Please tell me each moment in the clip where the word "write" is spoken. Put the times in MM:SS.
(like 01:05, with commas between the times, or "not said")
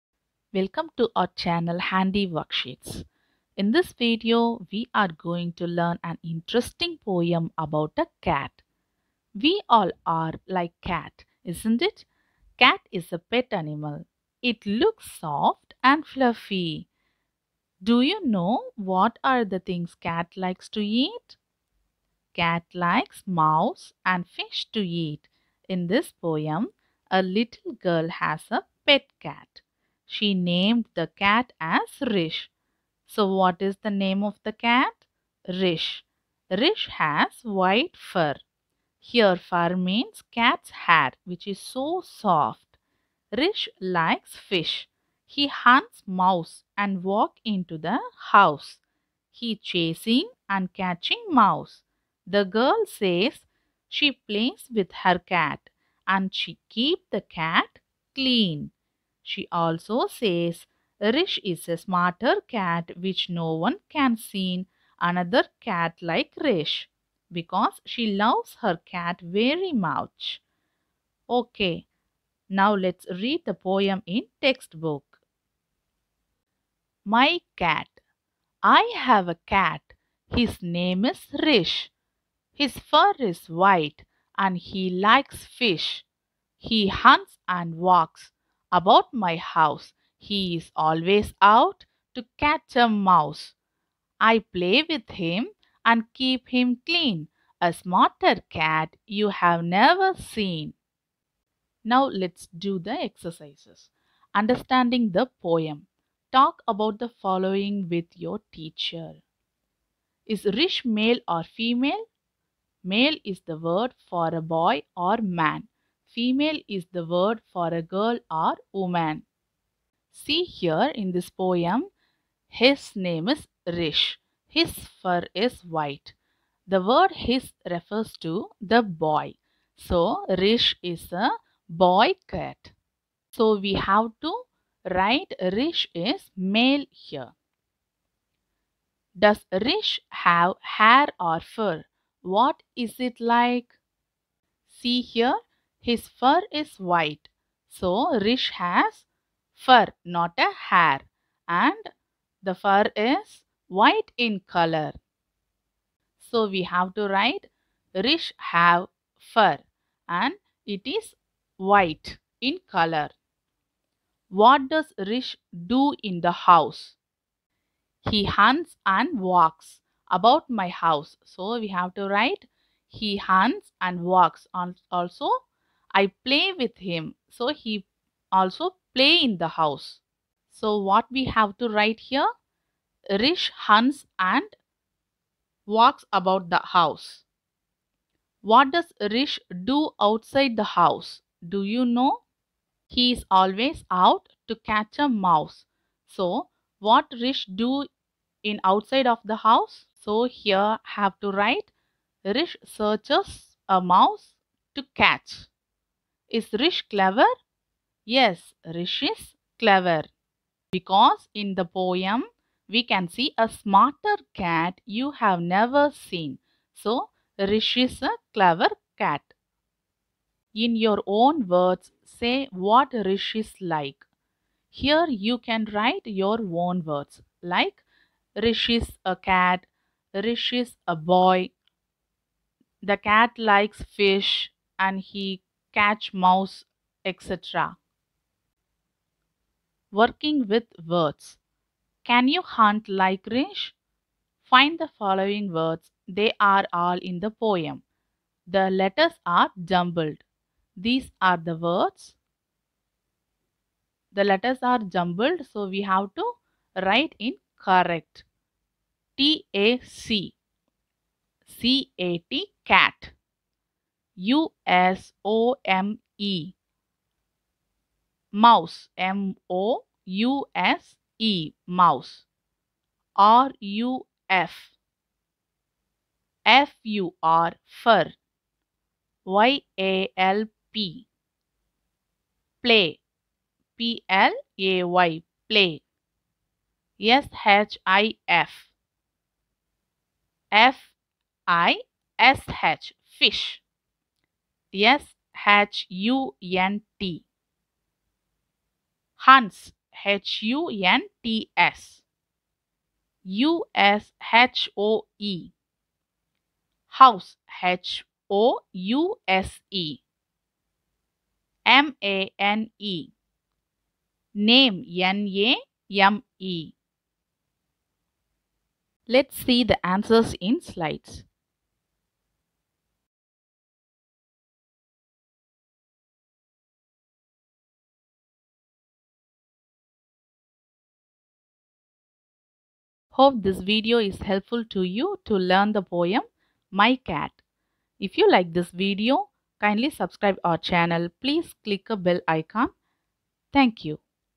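02:14, 02:37, 02:52, 03:01, 03:21, 03:45, 04:16.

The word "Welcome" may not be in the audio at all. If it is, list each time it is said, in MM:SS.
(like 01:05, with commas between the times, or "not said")
00:00.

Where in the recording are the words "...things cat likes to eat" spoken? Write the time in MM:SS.
00:19.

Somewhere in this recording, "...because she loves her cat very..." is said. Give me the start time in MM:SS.
01:07.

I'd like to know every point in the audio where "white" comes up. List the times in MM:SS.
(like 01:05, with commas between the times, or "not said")
00:37, 01:23, 02:05, 02:26, 02:33, 02:41.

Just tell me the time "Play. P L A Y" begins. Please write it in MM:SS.
04:42.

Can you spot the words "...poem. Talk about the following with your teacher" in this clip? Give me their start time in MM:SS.
01:45.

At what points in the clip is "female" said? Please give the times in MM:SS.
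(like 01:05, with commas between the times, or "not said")
01:51, 01:56.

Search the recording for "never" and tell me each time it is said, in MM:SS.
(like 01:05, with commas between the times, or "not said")
01:39, 03:35.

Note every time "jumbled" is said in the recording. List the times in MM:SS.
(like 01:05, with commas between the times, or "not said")
04:09, 04:14.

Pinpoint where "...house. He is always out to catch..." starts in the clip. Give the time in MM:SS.
01:29.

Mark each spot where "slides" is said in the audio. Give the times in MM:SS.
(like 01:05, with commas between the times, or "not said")
05:20.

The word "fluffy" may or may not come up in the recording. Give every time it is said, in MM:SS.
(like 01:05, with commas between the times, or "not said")
00:16.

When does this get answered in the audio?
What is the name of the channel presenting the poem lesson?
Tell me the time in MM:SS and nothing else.
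00:01.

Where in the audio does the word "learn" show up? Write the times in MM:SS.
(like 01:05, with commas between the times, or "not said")
00:05, 05:35.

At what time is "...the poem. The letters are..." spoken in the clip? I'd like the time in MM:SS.
04:07.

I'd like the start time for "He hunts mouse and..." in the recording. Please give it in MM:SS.
00:45.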